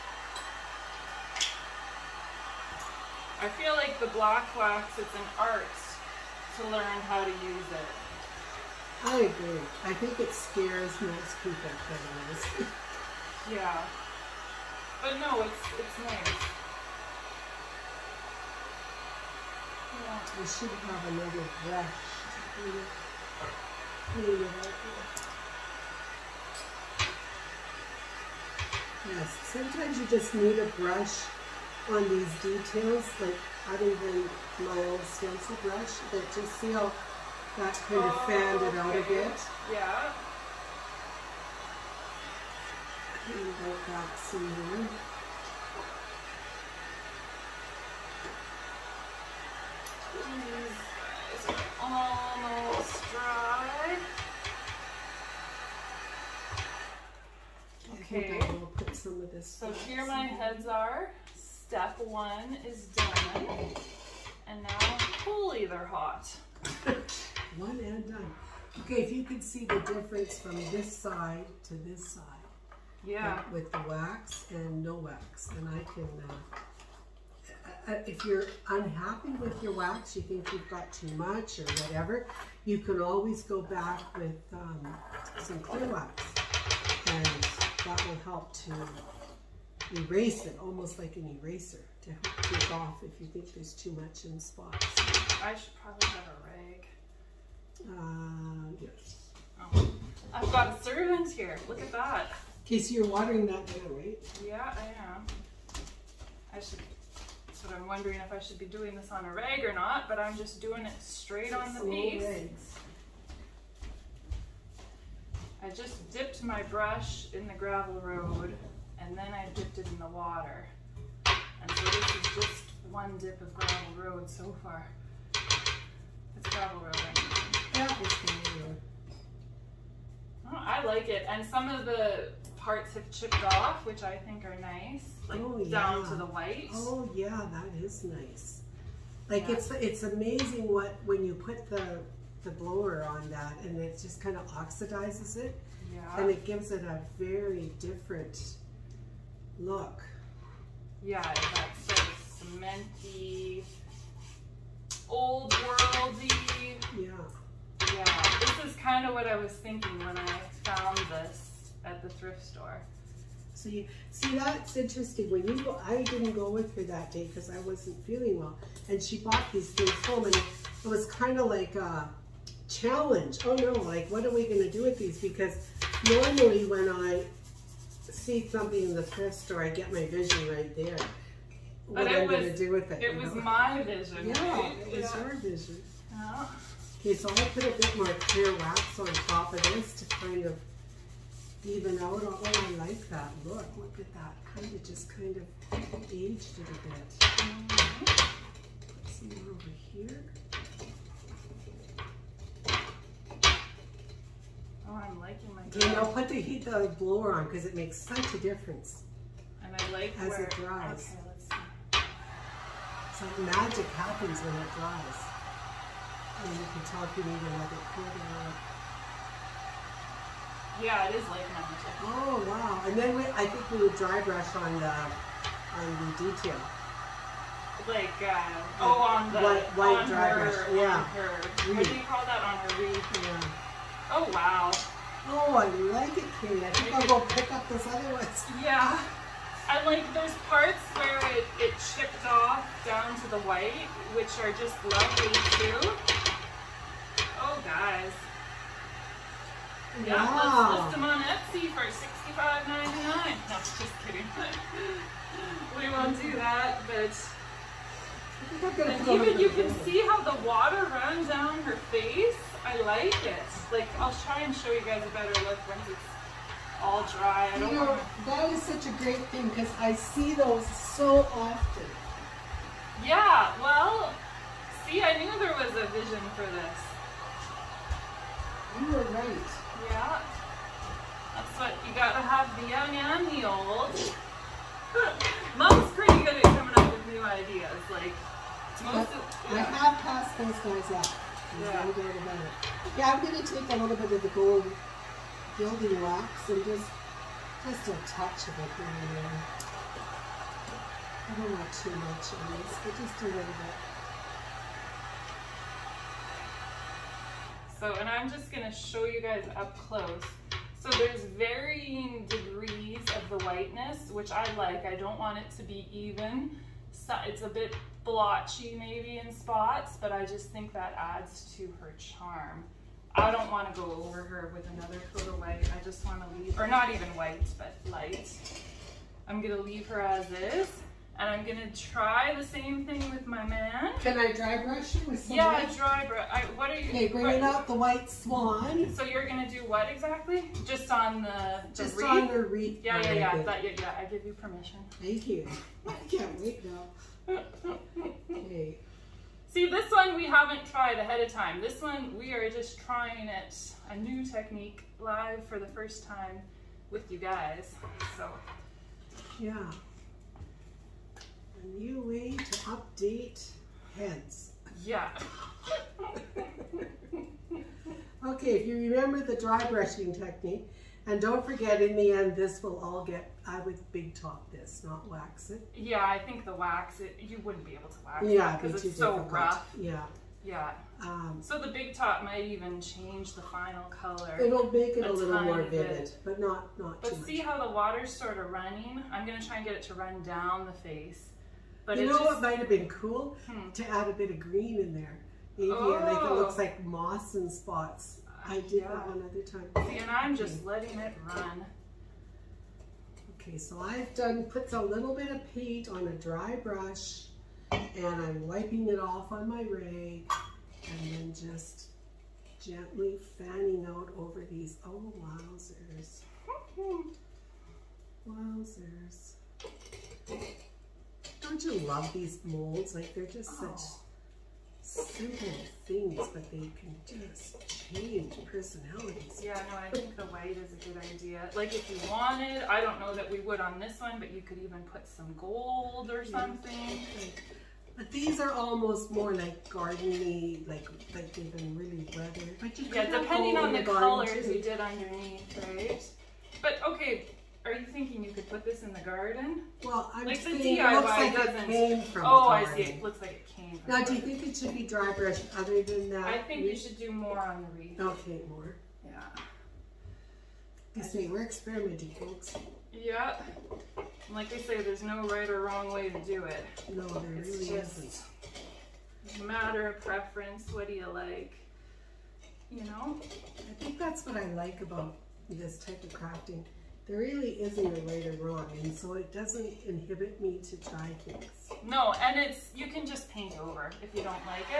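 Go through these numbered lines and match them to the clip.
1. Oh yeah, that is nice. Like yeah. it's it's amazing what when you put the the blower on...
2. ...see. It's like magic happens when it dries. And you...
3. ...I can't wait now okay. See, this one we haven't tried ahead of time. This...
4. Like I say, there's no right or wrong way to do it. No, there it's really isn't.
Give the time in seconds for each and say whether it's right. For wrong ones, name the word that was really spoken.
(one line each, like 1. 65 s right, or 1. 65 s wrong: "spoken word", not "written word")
1. 136 s right
2. 211 s right
3. 345 s right
4. 464 s right.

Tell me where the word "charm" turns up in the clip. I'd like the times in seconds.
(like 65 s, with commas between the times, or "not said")
321 s.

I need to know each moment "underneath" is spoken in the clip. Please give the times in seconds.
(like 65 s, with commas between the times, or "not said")
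444 s.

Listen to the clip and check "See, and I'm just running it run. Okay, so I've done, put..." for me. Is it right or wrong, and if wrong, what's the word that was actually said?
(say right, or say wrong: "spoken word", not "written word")
wrong: "letting", not "running".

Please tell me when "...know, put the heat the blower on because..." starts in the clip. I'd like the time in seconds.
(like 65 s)
205 s.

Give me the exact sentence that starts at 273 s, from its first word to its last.
Yeah, well, see, I knew there was a vision for this.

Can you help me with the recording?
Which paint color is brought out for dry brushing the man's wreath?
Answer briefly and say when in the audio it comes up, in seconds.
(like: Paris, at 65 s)
white swan, at 337 s.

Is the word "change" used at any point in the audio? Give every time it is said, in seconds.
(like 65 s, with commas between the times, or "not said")
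382 s, 427 s.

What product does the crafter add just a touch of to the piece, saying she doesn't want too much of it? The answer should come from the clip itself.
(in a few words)
gold gilding wax.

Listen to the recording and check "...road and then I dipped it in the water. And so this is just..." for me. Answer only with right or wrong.
right.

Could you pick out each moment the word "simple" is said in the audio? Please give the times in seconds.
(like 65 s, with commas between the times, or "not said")
424 s.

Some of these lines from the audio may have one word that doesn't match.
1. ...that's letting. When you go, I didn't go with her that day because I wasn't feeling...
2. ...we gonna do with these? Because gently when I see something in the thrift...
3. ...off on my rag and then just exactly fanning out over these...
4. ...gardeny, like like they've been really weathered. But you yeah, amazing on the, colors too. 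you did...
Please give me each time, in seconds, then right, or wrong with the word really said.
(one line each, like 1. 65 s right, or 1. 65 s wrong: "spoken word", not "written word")
1. 164 s wrong: "interesting", not "letting"
2. 174 s wrong: "normally", not "gently"
3. 408 s wrong: "gently", not "exactly"
4. 439 s wrong: "depending", not "amazing".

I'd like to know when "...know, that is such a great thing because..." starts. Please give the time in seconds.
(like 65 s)
267 s.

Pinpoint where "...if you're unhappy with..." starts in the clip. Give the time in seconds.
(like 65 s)
78 s.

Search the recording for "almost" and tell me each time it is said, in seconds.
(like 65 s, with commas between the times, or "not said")
51 s, 90 s, 438 s.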